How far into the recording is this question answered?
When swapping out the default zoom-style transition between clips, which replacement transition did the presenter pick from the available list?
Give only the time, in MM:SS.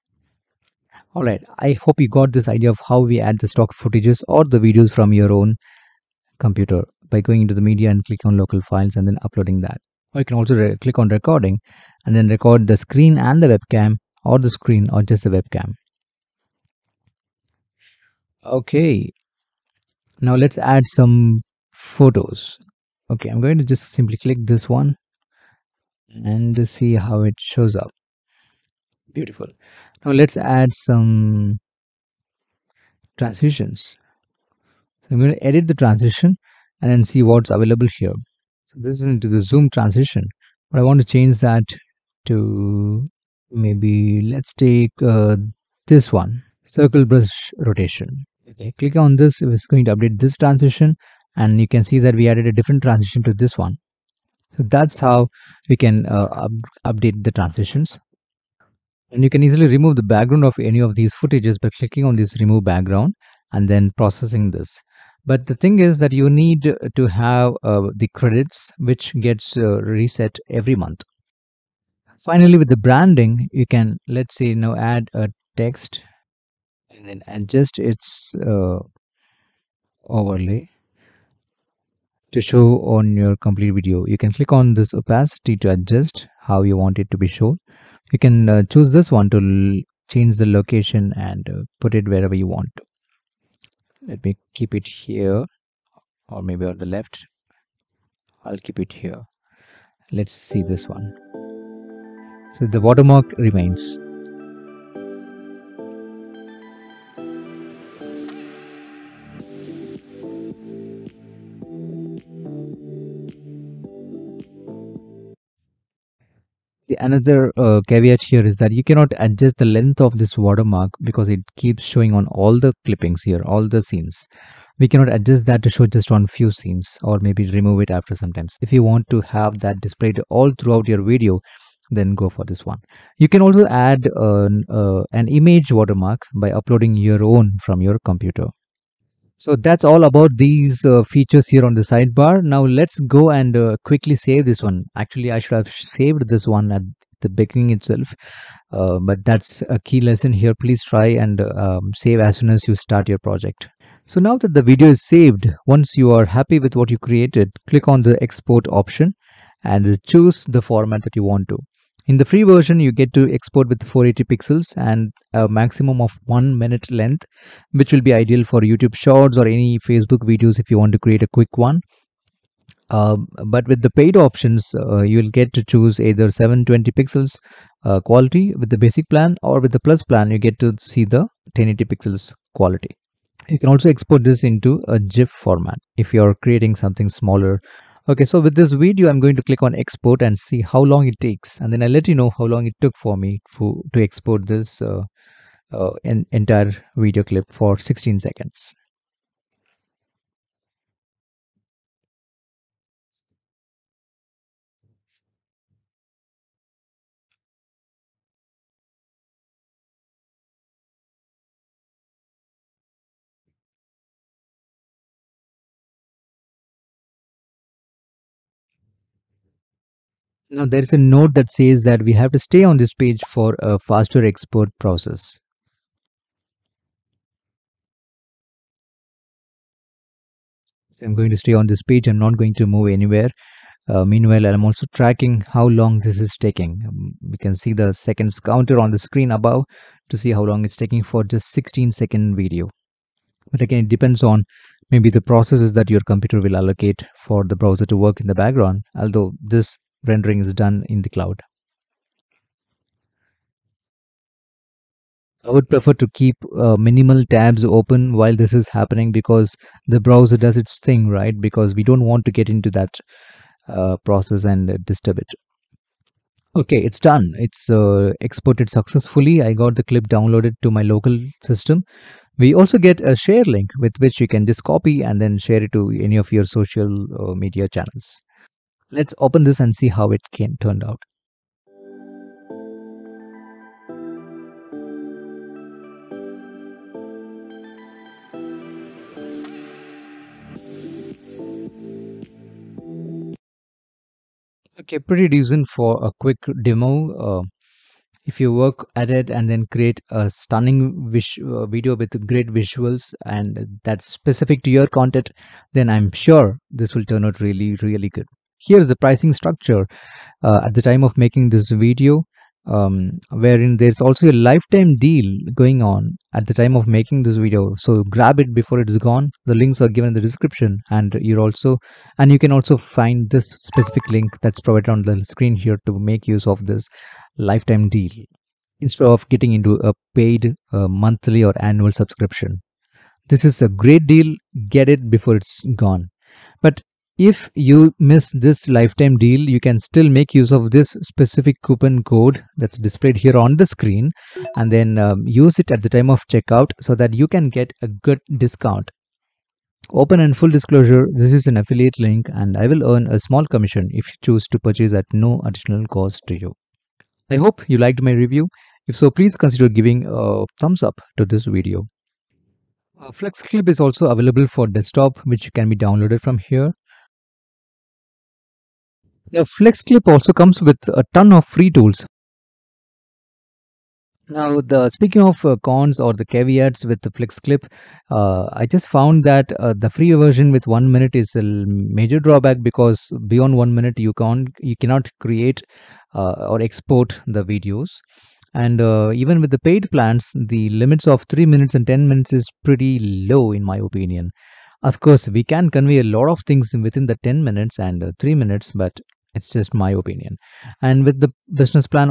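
00:46.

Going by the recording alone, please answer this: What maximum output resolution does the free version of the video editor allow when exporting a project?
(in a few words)
480 pixels.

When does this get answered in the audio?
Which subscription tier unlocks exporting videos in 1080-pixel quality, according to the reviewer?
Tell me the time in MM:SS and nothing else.
02:59.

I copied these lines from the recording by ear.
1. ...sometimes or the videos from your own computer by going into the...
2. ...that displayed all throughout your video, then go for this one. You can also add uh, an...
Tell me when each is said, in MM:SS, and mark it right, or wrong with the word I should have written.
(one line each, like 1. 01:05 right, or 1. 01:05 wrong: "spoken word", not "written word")
1. 00:03 wrong: "footages", not "sometimes"
2. 02:09 right.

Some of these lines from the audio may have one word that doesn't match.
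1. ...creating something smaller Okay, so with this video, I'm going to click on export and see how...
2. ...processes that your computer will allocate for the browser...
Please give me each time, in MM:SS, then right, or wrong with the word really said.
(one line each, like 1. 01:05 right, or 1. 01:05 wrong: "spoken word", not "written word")
1. 03:06 right
2. 04:05 right.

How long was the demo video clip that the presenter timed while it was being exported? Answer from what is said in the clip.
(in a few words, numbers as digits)
16 seconds.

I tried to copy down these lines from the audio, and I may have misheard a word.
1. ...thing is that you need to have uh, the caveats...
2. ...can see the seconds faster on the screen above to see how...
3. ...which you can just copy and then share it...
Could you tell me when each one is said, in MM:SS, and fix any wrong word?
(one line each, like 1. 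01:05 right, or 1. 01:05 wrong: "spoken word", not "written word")
1. 01:05 wrong: "credits", not "caveats"
2. 03:57 wrong: "counter", not "faster"
3. 04:33 right.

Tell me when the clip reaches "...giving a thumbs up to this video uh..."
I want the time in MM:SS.
05:59.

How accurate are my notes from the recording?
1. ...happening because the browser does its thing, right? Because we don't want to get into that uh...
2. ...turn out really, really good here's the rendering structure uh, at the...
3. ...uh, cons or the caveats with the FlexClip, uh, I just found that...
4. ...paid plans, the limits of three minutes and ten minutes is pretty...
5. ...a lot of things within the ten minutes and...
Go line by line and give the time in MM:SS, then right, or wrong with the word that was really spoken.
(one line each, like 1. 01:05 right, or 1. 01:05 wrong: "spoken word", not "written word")
1. 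04:18 right
2. 05:07 wrong: "pricing", not "rendering"
3. 06:15 right
4. 06:29 right
5. 06:35 right.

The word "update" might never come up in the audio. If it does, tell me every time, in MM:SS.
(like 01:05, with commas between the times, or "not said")
00:49, 00:56.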